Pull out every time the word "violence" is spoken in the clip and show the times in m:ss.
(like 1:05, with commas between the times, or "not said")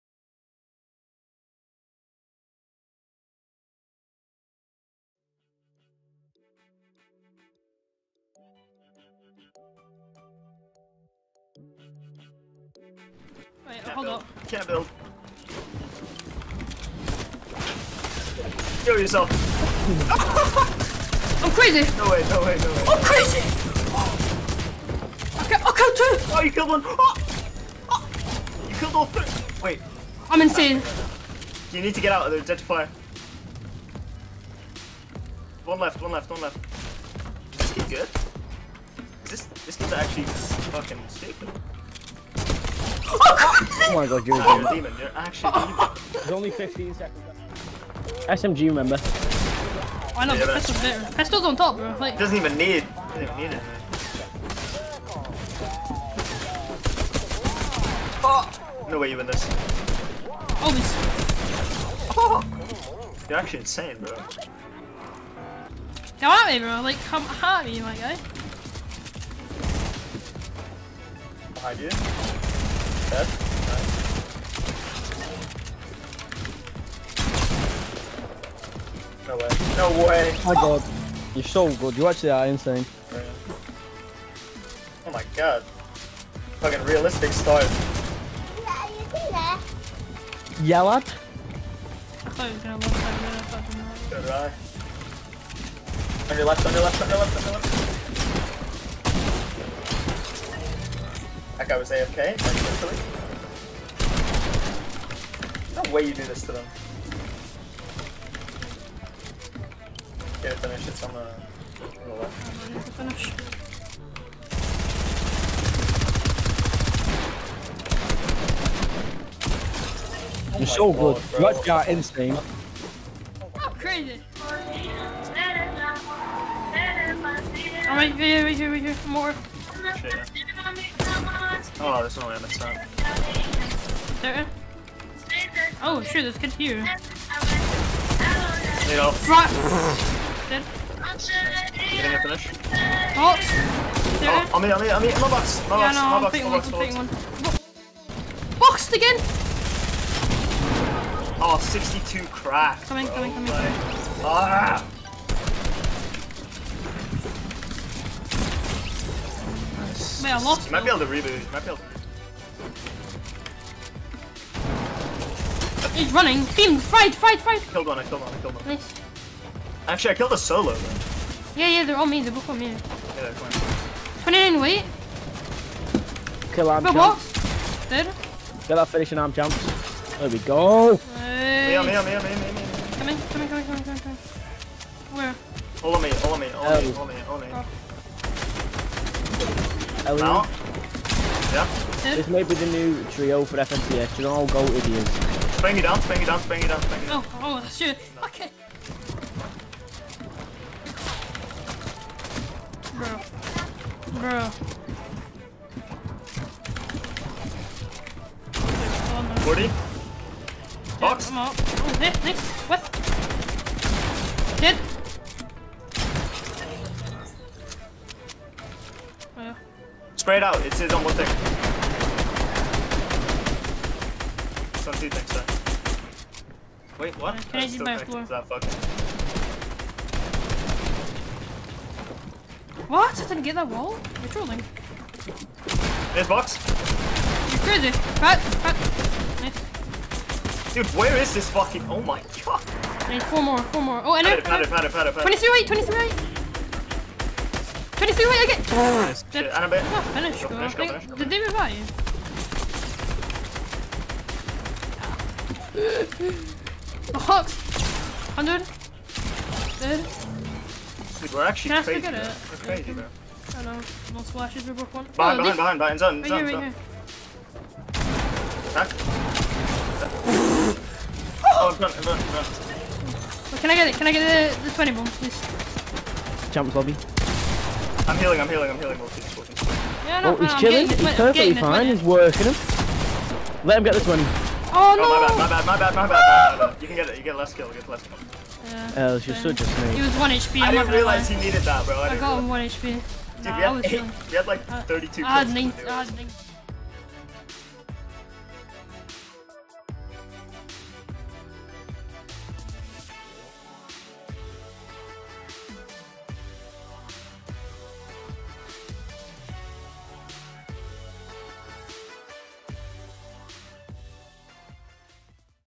not said.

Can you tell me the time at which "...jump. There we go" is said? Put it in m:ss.
2:59.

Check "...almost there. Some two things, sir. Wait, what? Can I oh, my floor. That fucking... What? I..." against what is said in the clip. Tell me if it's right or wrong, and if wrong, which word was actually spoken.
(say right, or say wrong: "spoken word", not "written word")
right.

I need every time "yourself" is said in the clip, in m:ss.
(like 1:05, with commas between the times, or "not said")
0:18.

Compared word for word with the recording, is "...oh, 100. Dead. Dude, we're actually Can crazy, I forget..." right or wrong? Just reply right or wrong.
right.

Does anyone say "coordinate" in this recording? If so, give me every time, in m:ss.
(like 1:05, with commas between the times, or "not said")
not said.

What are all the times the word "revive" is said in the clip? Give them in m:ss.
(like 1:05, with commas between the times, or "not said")
4:11.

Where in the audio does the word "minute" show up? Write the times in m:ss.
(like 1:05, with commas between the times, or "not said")
4:41.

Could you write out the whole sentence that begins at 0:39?
this this game's actually fucking stupid.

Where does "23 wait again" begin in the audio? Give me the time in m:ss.
4:08.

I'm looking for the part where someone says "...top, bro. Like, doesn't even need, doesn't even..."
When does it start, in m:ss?
0:51.